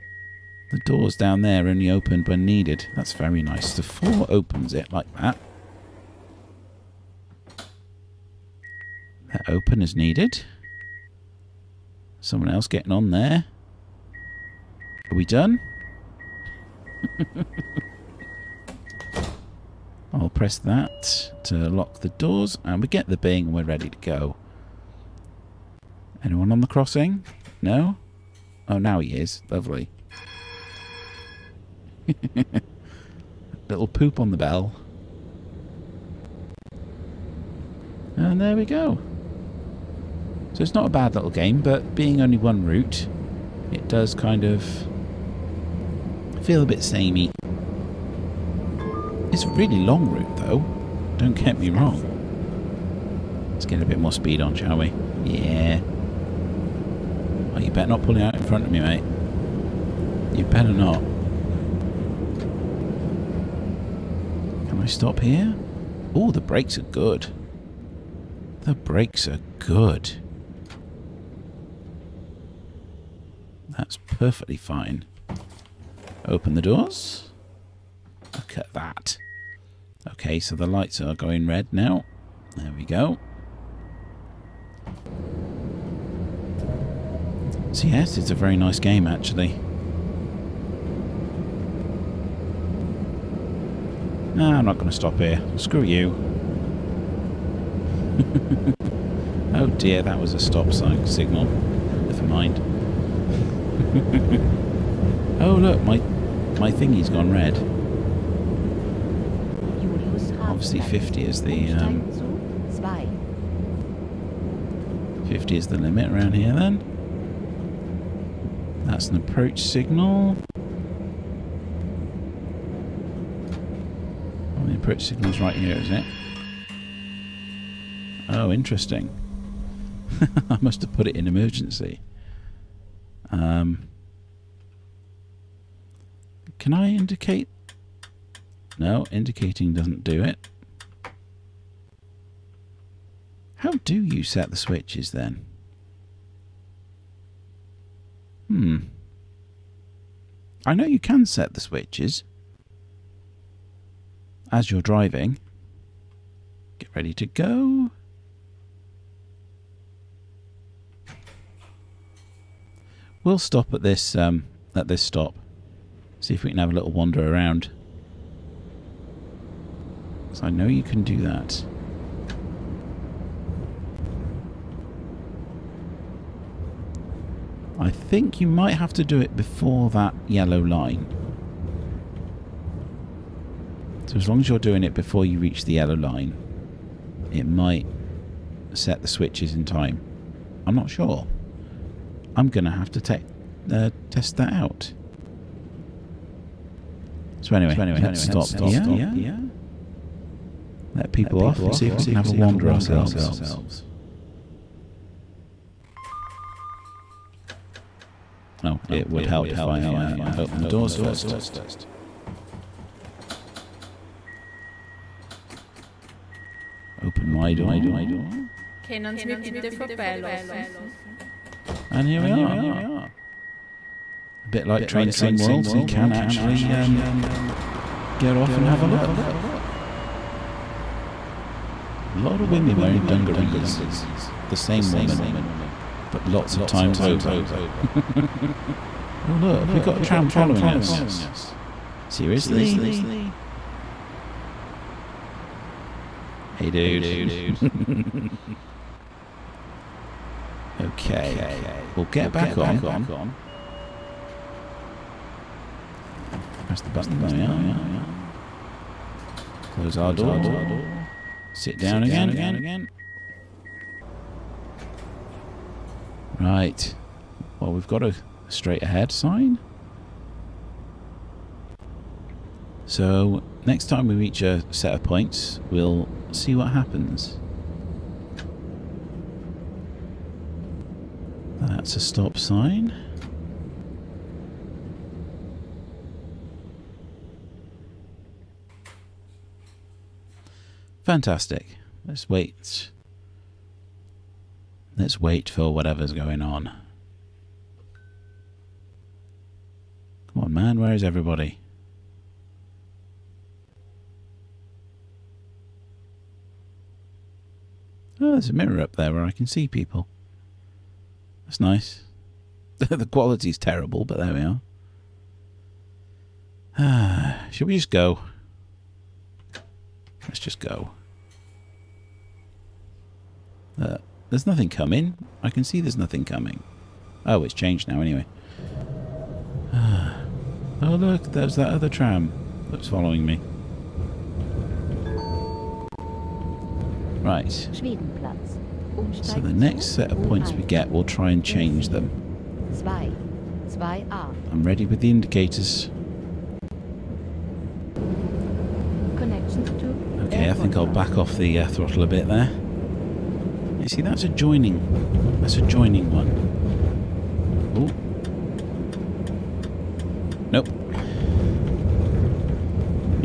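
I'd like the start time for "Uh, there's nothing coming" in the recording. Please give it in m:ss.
5:23.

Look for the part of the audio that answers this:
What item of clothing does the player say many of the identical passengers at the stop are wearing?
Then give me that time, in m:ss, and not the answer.
3:53.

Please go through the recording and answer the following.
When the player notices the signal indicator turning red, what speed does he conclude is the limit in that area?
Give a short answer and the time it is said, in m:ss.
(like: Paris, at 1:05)
50, at 1:55.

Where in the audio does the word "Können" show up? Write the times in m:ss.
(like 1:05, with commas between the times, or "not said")
3:38.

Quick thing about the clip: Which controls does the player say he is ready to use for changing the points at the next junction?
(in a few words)
indicators.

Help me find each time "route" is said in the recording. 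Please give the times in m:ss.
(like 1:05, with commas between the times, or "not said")
0:42, 0:50.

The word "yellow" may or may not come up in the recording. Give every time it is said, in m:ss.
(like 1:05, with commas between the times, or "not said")
3:00, 3:05.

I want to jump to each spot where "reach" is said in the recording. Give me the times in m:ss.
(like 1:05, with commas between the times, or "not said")
3:05, 4:34.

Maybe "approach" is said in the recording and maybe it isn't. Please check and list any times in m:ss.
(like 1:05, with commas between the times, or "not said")
1:59, 2:04.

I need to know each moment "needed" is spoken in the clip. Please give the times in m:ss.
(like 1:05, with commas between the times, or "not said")
0:02, 0:09.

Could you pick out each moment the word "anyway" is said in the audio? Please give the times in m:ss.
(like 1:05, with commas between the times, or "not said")
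3:17, 5:28.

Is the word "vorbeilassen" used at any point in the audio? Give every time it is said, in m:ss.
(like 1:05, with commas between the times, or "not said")
3:39.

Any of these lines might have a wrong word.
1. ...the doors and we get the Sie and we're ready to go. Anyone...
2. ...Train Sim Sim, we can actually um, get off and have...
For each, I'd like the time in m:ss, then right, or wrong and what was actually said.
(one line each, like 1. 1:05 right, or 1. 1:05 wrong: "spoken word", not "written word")
1. 0:21 wrong: "Bing", not "Sie"
2. 3:44 wrong: "World", not "Sim".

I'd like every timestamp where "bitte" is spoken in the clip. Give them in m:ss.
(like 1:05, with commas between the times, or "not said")
3:39.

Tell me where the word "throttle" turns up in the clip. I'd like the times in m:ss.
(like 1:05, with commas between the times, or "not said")
5:51.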